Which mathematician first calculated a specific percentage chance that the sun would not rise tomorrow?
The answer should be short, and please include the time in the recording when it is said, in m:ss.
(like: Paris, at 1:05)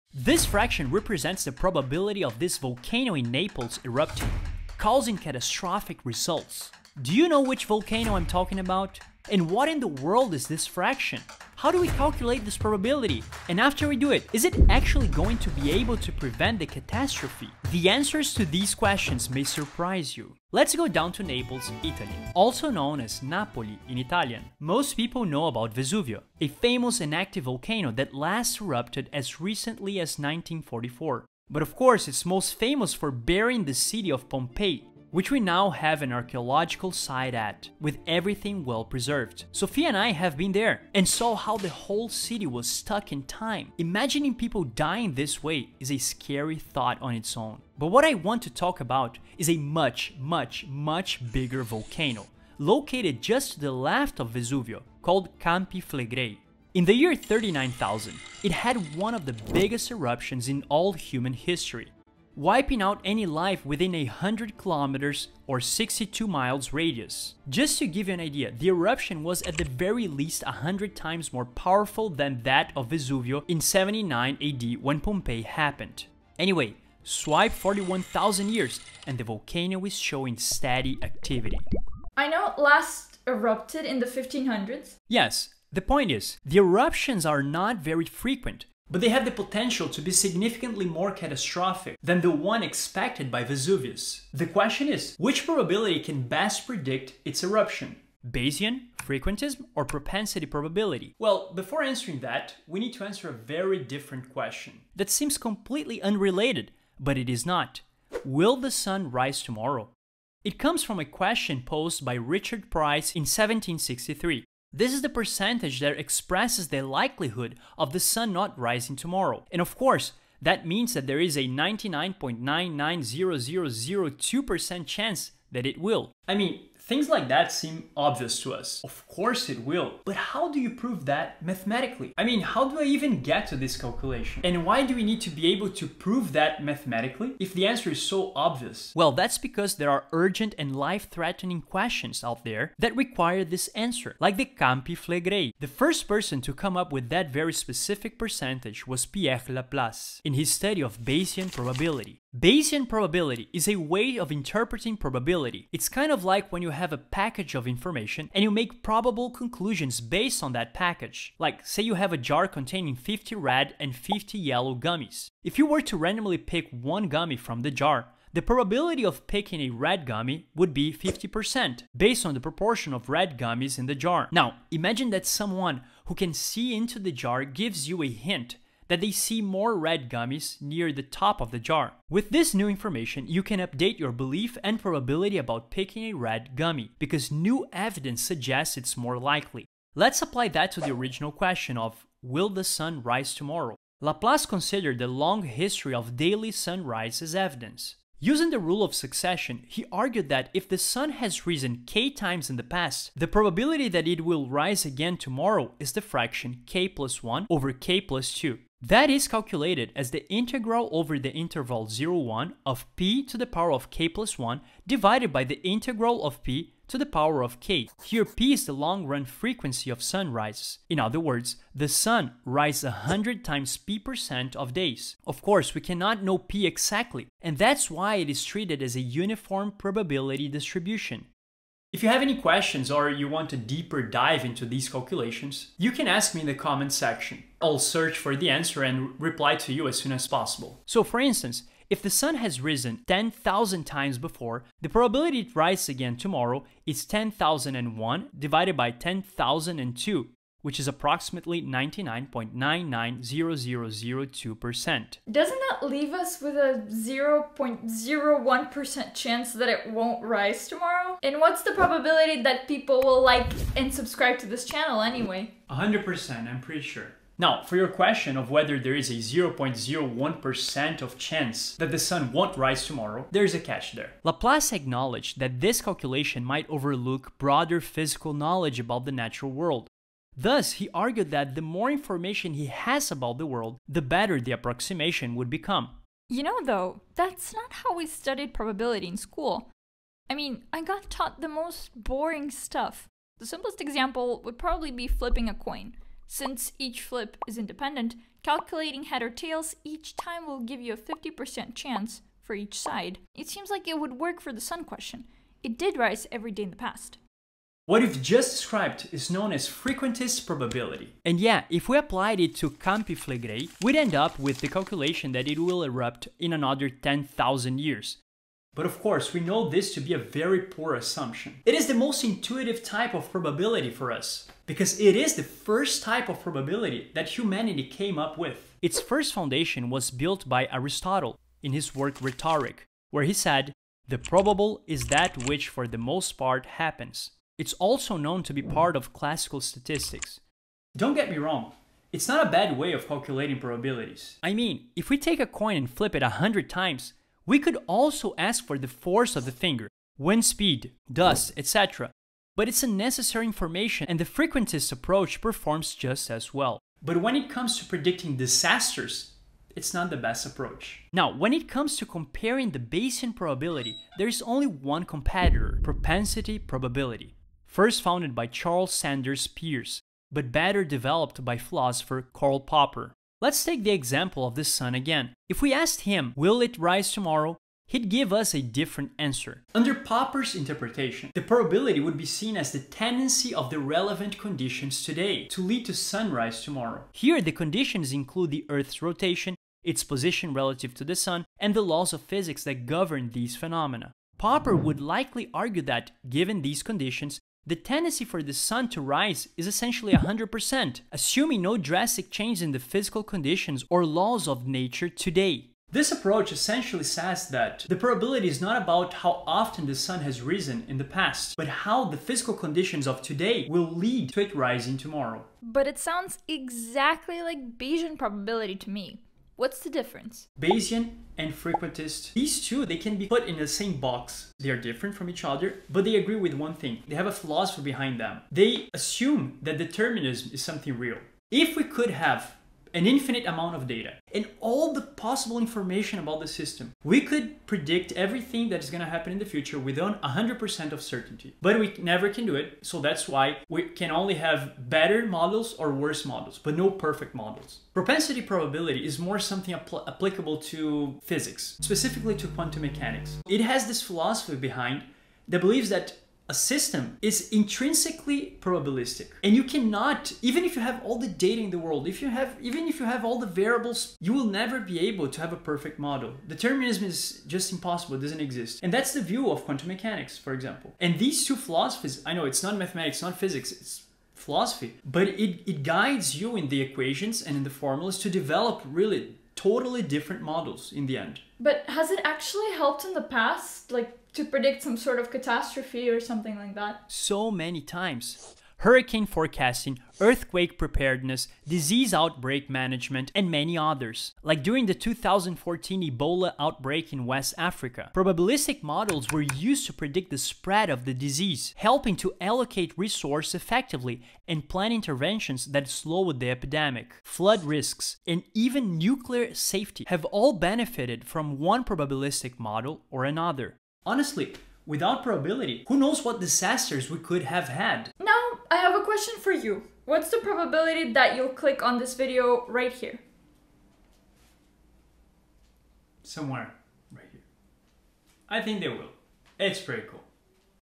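Pierre Laplace, at 2:29.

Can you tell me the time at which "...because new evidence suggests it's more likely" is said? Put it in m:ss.
3:06.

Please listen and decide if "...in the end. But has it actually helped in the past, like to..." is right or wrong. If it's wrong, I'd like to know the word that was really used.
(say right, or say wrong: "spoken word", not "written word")
right.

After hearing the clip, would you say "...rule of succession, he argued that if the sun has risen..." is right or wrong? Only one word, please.
right.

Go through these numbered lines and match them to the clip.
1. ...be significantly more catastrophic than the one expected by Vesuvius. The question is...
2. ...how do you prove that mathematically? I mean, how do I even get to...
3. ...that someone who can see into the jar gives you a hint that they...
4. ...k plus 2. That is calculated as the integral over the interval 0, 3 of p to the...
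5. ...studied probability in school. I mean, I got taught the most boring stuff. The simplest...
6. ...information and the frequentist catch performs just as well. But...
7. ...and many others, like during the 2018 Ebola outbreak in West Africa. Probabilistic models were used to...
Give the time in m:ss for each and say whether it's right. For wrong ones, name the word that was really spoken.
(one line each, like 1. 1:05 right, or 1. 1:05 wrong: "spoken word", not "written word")
1. 1:30 right
2. 2:10 right
3. 2:55 right
4. 3:27 wrong: "1", not "3"
5. 4:48 right
6. 5:53 wrong: "approach", not "catch"
7. 8:13 wrong: "2014", not "2018".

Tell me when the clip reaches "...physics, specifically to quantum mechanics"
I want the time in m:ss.
7:31.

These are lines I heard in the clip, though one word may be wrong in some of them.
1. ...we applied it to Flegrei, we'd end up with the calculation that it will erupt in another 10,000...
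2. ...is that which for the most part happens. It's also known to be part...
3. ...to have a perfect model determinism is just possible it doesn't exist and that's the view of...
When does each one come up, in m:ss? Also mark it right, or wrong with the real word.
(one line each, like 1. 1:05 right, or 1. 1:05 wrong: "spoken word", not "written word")
1. 5:11 right
2. 5:34 right
3. 7:45 wrong: "impossible", not "possible".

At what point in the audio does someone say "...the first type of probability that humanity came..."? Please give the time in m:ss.
5:25.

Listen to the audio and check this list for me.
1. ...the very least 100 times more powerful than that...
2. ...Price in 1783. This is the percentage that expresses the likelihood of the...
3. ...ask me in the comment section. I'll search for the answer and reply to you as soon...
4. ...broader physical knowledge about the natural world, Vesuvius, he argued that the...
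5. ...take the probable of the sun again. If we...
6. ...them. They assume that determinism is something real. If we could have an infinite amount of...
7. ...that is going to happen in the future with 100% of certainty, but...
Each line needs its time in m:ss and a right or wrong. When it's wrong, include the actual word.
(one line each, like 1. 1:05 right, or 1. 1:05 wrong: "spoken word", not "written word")
1. 1:09 right
2. 1:52 wrong: "1763", not "1783"
3. 3:56 right
4. 4:37 wrong: "Thus", not "Vesuvius"
5. 6:13 wrong: "example", not "probable"
6. 7:08 right
7. 7:18 right.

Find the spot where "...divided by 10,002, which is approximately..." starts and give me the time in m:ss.
4:08.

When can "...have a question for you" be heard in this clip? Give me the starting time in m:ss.
8:38.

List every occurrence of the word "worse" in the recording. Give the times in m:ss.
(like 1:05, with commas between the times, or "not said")
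7:25.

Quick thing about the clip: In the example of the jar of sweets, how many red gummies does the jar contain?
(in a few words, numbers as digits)
50.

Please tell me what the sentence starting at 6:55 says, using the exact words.
But it sounds exactly like Bayesian probability to me.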